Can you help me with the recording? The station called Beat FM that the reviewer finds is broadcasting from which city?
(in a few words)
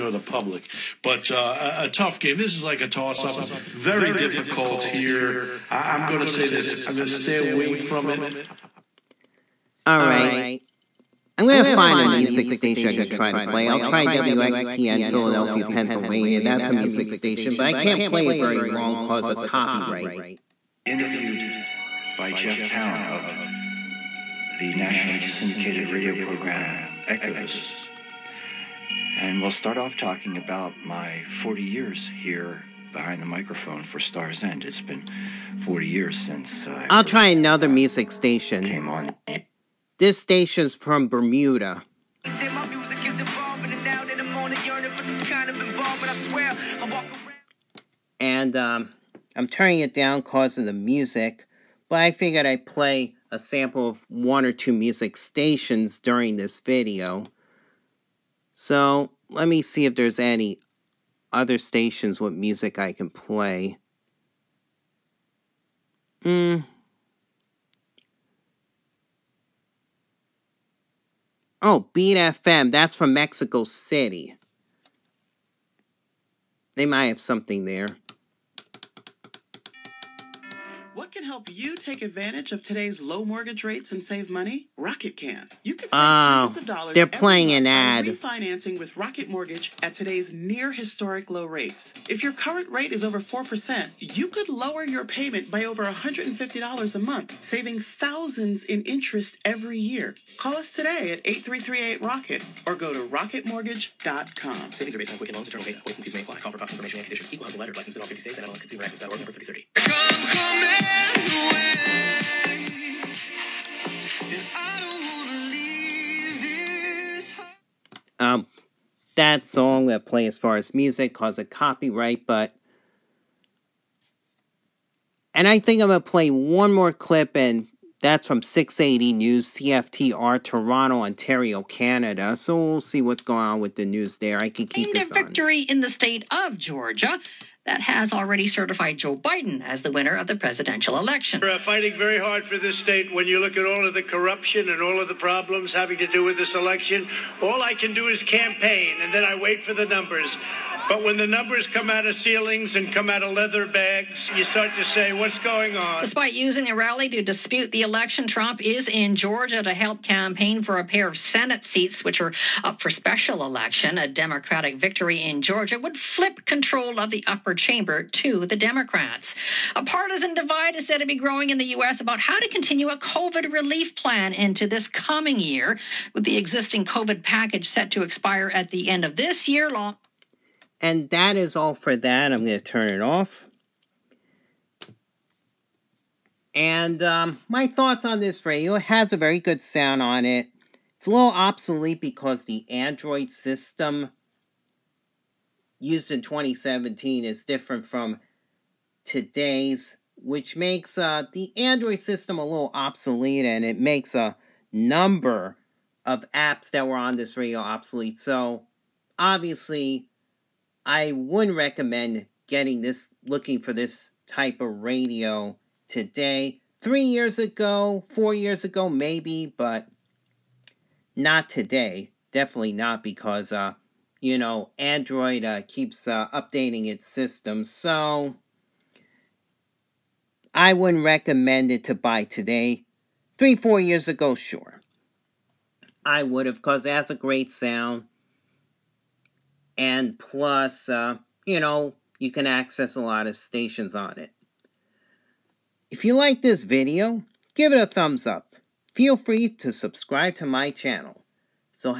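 Mexico City.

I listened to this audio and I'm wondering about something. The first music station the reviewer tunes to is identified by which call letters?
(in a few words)
WXPN.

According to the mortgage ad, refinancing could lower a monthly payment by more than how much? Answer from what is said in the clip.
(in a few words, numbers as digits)
$150.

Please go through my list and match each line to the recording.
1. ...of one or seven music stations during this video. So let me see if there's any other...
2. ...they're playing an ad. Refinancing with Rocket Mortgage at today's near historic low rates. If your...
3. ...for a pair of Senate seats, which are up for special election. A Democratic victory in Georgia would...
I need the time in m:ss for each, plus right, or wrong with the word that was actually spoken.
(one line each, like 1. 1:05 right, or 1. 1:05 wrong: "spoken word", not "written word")
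1. 0:53 wrong: "two", not "seven"
2. 1:26 right
3. 2:40 right.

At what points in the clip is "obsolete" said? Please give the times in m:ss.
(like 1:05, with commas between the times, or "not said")
3:11, 3:22, 3:27.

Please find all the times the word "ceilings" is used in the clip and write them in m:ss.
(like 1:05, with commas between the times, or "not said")
2:32.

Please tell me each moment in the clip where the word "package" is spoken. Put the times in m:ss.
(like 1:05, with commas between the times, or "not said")
2:57.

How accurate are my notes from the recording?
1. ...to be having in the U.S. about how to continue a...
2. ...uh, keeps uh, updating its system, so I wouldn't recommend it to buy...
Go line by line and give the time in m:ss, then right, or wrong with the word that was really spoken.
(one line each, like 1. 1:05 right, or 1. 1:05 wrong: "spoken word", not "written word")
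1. 2:50 wrong: "growing", not "having"
2. 3:45 right.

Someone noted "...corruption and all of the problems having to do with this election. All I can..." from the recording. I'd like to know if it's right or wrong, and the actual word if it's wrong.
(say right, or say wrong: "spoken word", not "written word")
right.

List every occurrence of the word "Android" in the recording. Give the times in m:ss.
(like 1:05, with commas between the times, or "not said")
3:12, 3:21, 3:44.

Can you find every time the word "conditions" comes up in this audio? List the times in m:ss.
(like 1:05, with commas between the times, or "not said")
1:47.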